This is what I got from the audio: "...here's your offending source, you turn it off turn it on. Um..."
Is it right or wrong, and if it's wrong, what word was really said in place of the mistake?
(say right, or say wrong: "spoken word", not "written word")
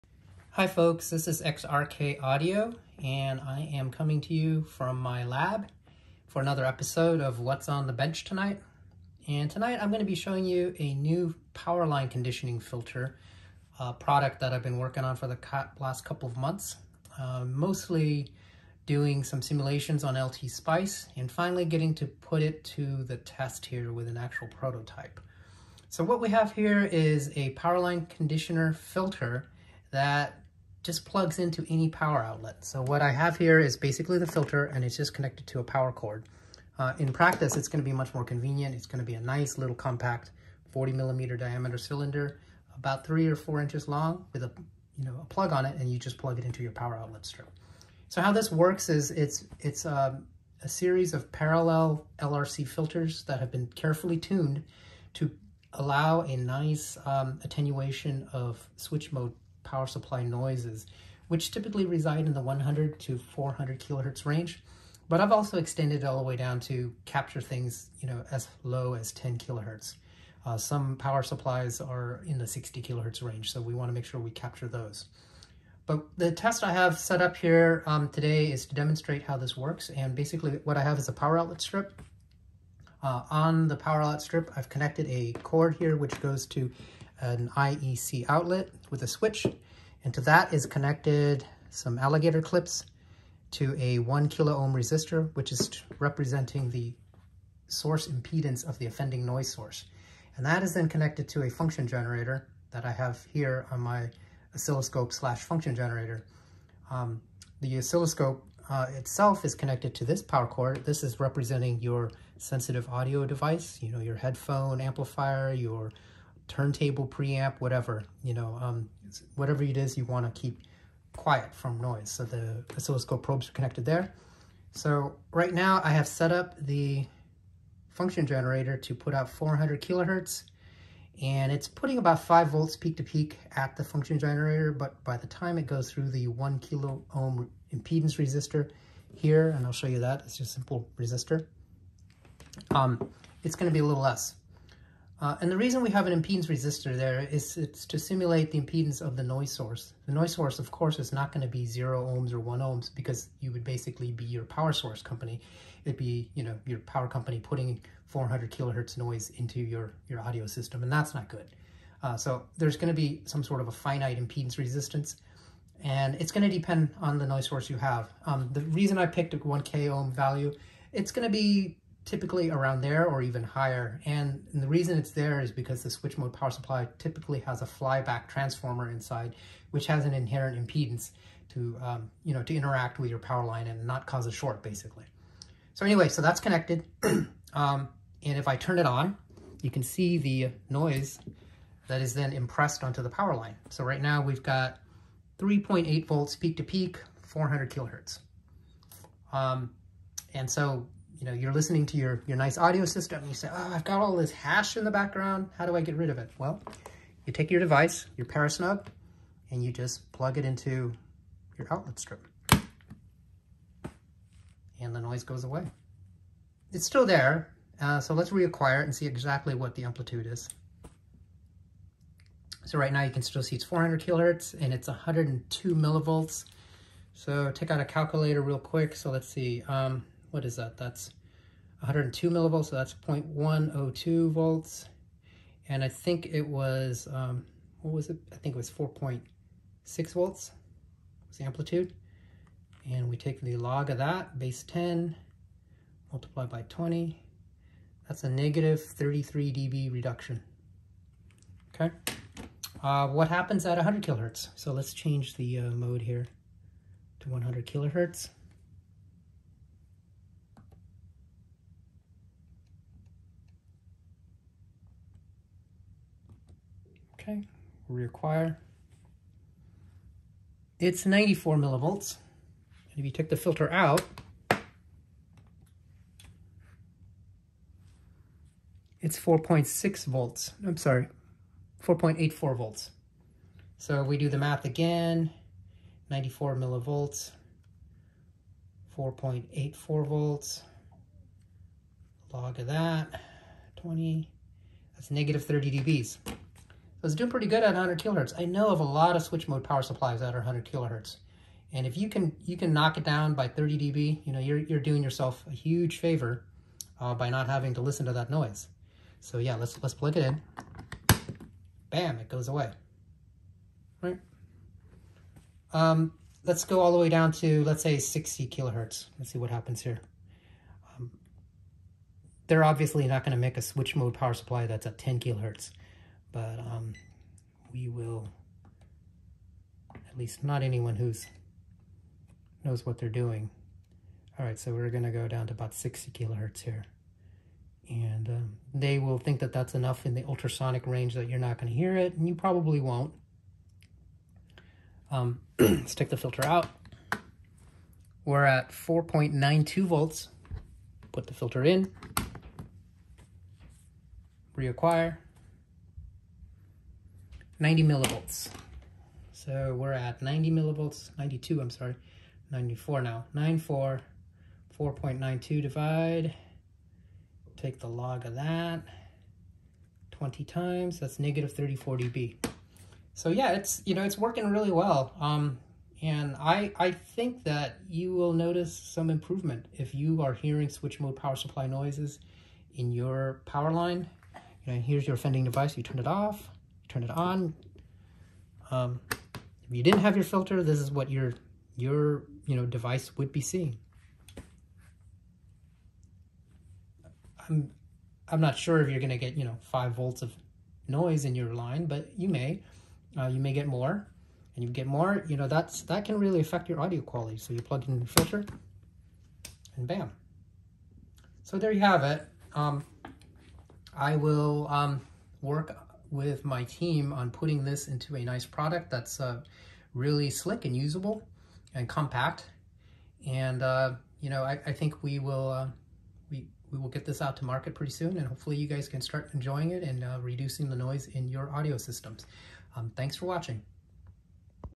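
wrong: "device", not "source".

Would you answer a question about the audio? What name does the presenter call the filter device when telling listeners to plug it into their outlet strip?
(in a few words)
Parasnub.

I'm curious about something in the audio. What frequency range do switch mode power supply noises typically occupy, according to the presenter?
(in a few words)
100 to 400 kilohertz.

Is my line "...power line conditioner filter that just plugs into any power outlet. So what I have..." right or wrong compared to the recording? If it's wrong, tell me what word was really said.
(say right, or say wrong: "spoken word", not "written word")
right.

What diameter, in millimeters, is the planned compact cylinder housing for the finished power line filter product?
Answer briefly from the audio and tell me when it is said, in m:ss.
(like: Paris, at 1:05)
40 millimeters, at 0:40.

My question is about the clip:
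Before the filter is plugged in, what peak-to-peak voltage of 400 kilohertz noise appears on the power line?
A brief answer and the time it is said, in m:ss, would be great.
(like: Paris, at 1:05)
3.8 volts, at 3:15.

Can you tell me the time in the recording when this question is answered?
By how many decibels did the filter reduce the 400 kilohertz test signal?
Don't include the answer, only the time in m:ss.
4:08.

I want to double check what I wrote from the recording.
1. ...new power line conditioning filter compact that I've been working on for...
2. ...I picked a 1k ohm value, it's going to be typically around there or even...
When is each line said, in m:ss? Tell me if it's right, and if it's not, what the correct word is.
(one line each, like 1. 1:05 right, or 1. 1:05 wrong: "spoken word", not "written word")
1. 0:10 wrong: "product", not "compact"
2. 2:48 right.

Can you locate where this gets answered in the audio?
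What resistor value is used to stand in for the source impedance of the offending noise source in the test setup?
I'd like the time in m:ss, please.
1:33.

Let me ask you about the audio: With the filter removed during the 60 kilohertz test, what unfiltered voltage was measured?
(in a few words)
4.92 volts.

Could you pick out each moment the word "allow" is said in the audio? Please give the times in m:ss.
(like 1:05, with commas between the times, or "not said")
0:55.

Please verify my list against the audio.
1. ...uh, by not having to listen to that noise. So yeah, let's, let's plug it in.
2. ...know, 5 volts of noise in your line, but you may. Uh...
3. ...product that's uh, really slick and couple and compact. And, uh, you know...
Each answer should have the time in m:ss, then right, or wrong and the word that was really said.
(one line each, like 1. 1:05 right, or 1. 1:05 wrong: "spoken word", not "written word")
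1. 5:06 right
2. 6:39 right
3. 6:58 wrong: "usable", not "couple".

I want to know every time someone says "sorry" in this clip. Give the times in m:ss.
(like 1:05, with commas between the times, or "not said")
4:40, 6:01.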